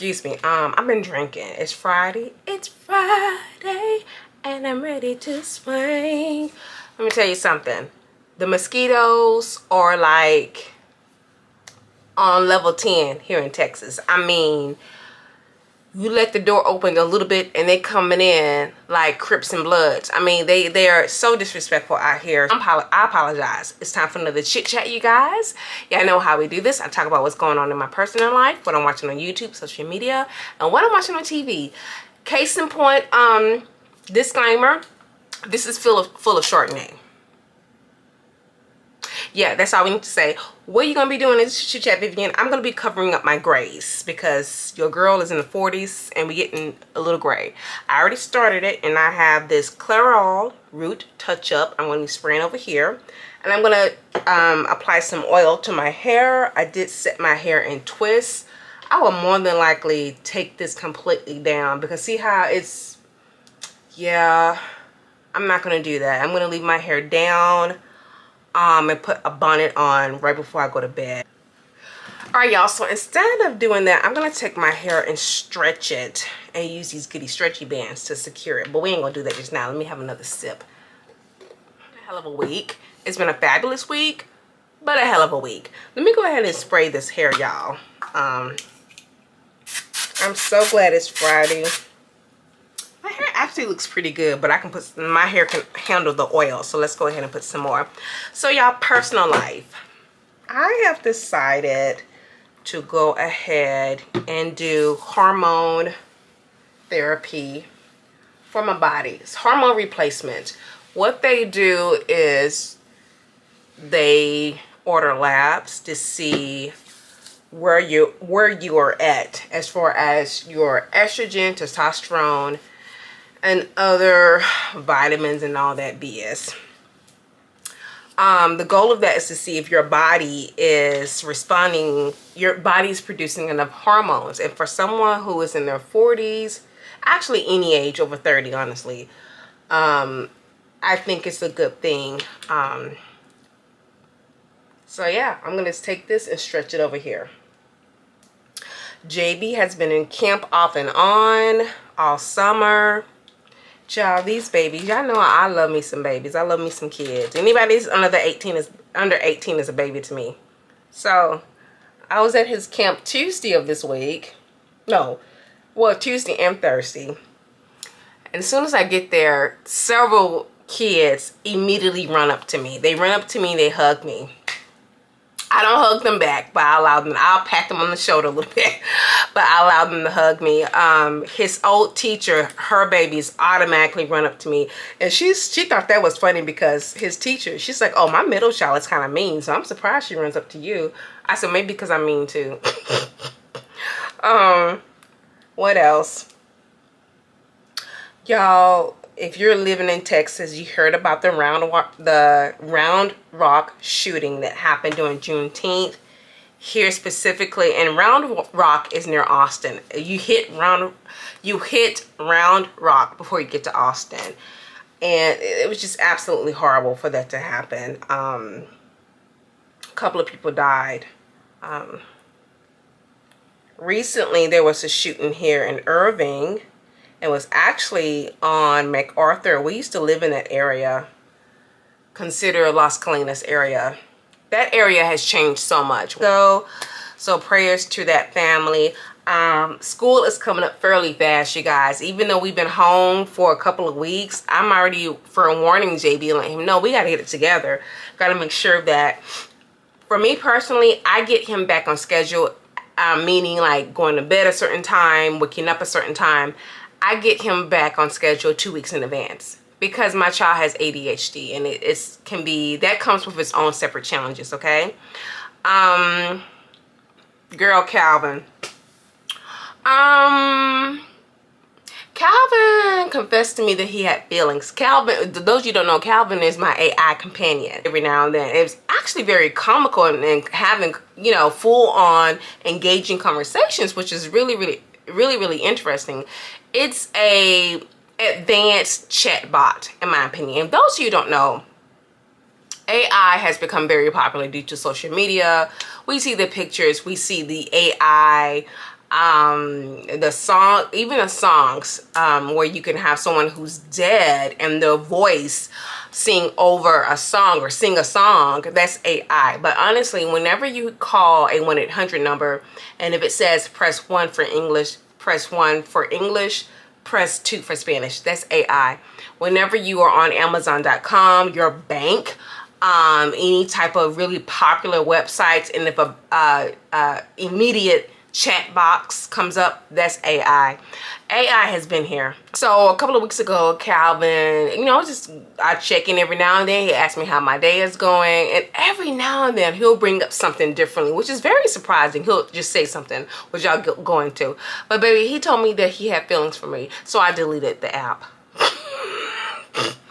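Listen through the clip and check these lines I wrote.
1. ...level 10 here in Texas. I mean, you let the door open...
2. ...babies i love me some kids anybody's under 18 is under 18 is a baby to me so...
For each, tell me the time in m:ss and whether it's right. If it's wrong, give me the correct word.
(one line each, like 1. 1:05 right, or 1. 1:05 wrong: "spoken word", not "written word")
1. 0:12 right
2. 2:36 right.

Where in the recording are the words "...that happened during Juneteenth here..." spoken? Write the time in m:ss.
3:24.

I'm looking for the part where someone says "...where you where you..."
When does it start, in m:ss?
1:57.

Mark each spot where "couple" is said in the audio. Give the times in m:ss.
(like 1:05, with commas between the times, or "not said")
3:39, 4:03, 5:32.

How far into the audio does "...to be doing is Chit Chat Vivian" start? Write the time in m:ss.
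0:41.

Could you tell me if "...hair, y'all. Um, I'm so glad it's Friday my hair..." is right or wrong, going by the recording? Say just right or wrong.
right.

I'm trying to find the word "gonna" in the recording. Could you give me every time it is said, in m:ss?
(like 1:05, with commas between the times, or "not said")
1:14, 1:19.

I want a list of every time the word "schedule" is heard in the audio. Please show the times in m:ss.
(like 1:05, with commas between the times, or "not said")
4:11, 4:18.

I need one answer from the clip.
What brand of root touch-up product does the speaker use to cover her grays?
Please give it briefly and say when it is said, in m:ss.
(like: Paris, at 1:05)
Clairol, at 0:49.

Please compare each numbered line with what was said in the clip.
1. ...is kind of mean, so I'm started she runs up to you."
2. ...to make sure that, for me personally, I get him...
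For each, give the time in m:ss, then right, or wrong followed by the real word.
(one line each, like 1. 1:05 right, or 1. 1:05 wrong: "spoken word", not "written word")
1. 3:08 wrong: "surprised", not "started"
2. 4:08 right.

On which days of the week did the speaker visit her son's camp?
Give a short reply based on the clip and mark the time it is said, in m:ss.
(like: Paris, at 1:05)
Tuesday and Thursday, at 2:45.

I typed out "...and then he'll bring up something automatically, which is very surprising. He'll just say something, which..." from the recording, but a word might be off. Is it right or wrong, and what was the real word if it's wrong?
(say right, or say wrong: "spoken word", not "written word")
wrong: "differently", not "automatically".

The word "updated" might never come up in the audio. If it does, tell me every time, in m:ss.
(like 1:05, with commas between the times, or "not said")
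not said.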